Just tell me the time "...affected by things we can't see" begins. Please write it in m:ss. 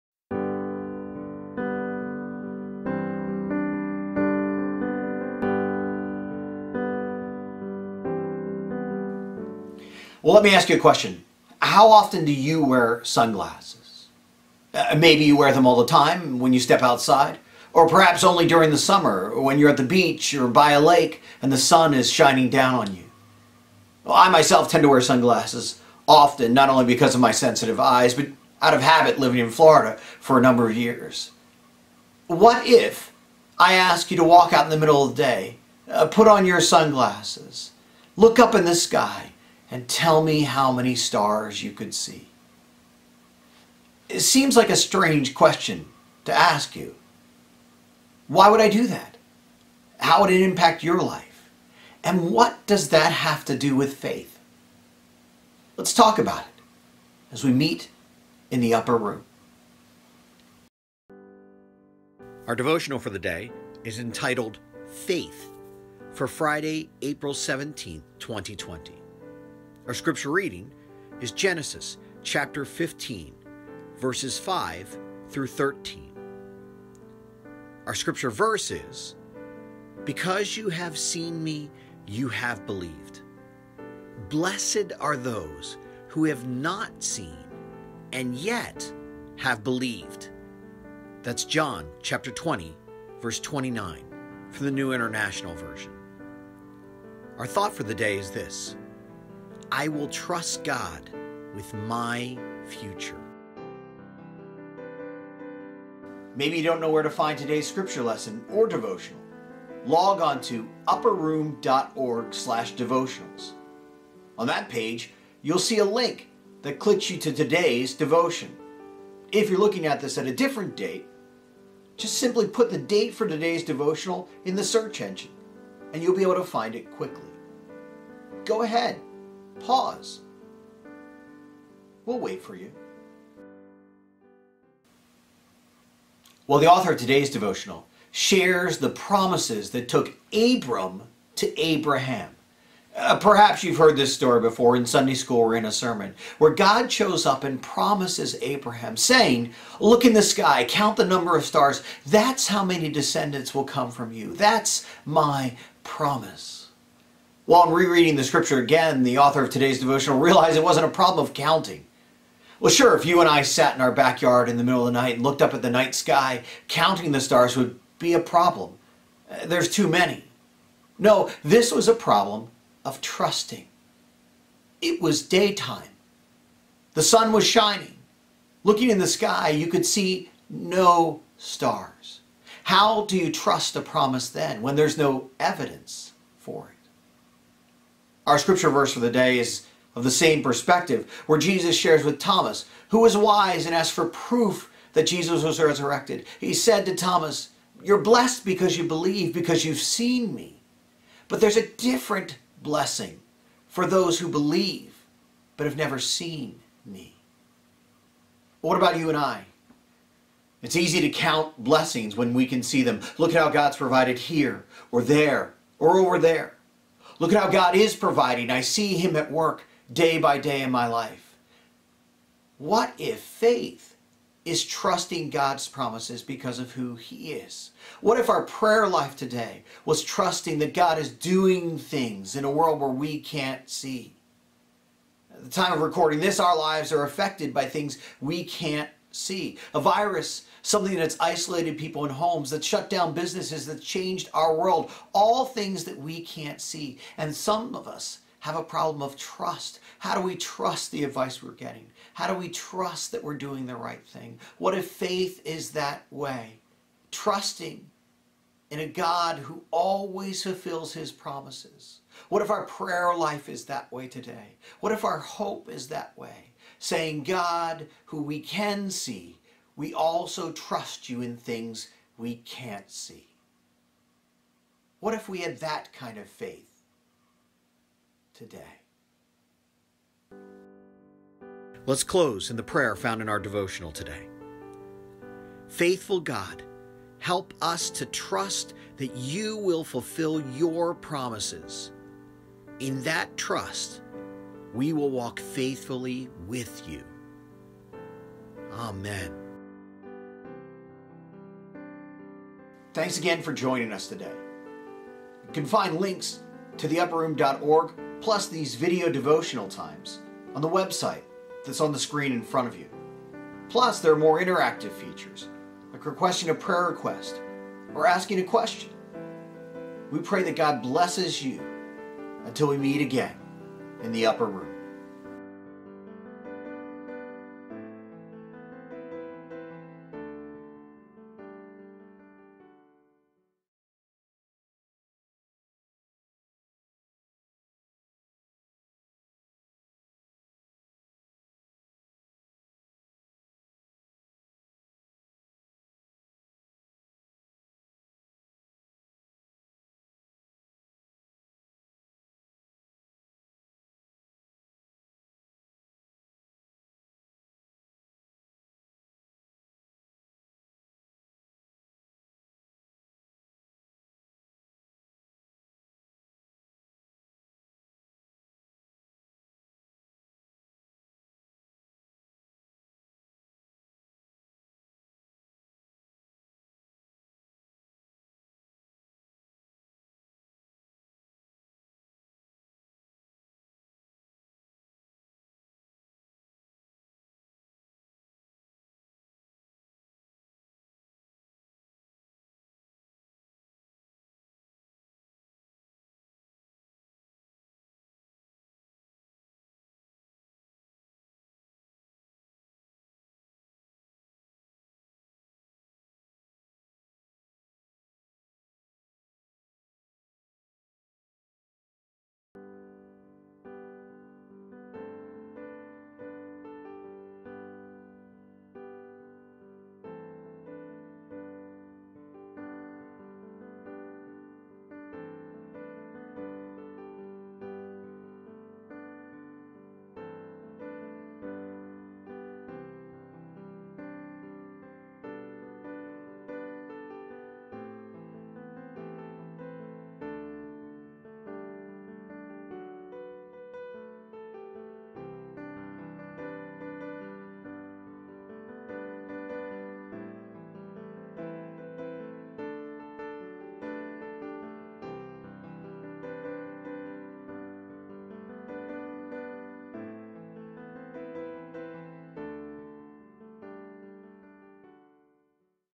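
3:57.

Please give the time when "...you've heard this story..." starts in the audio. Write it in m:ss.
2:23.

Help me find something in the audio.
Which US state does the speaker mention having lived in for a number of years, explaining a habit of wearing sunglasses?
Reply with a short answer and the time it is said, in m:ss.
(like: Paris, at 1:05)
Florida, at 0:29.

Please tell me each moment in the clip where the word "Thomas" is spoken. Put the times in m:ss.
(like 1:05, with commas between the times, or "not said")
3:12, 3:16.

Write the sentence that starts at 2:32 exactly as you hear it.
That's how many descendants will come from you.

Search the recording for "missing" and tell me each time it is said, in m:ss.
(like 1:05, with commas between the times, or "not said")
not said.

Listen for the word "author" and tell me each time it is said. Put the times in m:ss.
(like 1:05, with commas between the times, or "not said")
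2:16, 2:39.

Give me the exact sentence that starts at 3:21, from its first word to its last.
But there's a different blessing for those who believe but have never seen me.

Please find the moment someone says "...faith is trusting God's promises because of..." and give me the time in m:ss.
3:43.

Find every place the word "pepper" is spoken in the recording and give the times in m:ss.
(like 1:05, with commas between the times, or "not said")
not said.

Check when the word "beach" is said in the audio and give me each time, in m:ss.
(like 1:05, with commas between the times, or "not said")
0:19.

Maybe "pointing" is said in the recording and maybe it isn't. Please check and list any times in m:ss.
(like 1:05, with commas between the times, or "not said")
not said.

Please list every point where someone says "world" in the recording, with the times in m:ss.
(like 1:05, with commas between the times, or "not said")
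3:52, 4:04.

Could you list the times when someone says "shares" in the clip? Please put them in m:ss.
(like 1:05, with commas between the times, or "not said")
2:18, 3:11.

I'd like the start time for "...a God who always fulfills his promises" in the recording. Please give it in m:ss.
4:18.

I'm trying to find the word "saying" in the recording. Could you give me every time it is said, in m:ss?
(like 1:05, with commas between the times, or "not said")
2:28, 4:26.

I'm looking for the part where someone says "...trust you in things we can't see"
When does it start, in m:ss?
4:30.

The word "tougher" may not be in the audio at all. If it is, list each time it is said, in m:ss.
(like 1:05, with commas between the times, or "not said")
not said.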